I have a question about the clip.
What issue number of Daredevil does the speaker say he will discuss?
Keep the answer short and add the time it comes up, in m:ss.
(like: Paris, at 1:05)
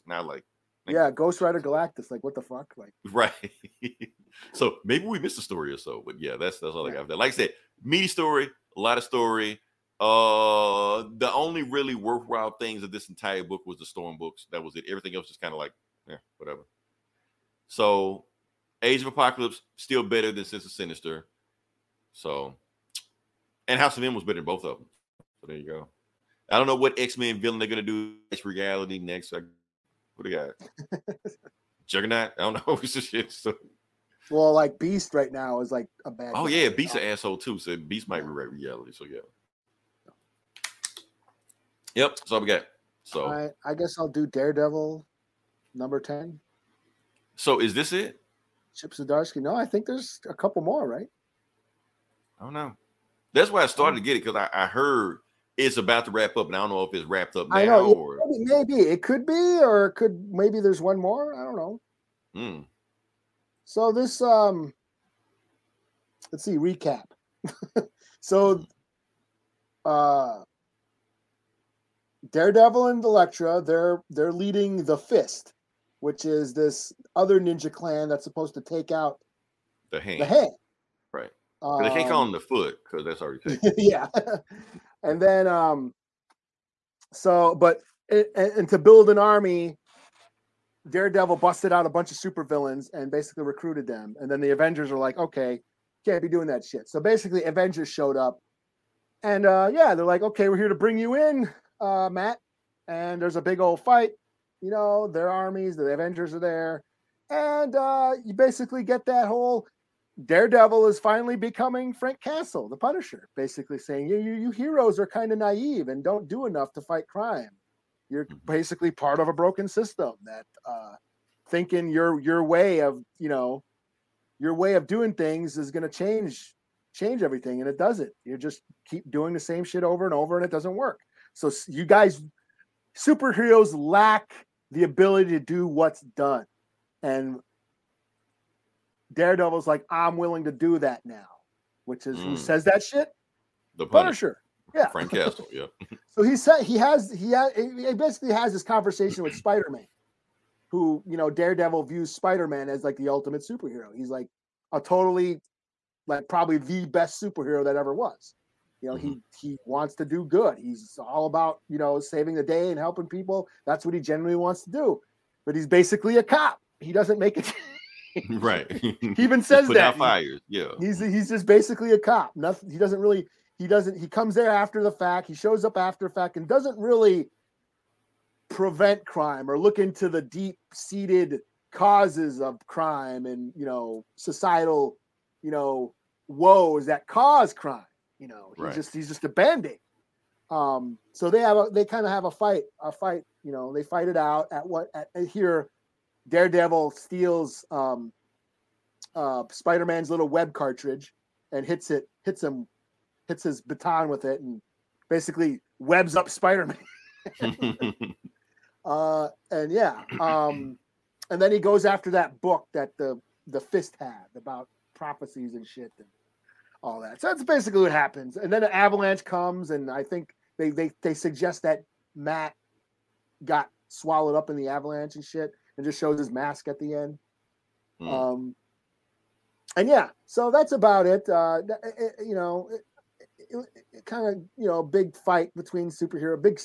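10, at 0:45.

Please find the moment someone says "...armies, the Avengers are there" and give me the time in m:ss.
1:45.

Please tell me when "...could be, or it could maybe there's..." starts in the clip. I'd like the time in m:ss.
0:59.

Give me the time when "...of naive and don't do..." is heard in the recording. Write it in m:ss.
1:55.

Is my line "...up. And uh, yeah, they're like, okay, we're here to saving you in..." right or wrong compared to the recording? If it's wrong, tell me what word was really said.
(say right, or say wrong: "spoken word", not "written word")
wrong: "bring", not "saving".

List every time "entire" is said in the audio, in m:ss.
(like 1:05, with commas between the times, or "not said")
0:13.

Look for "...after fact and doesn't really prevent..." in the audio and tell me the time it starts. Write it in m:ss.
2:55.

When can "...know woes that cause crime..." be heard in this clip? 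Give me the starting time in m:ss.
3:05.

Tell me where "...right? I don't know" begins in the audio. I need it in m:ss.
0:50.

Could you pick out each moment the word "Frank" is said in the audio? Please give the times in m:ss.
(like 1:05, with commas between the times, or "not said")
1:51, 2:24.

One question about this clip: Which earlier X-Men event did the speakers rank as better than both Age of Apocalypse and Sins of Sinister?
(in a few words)
House of M.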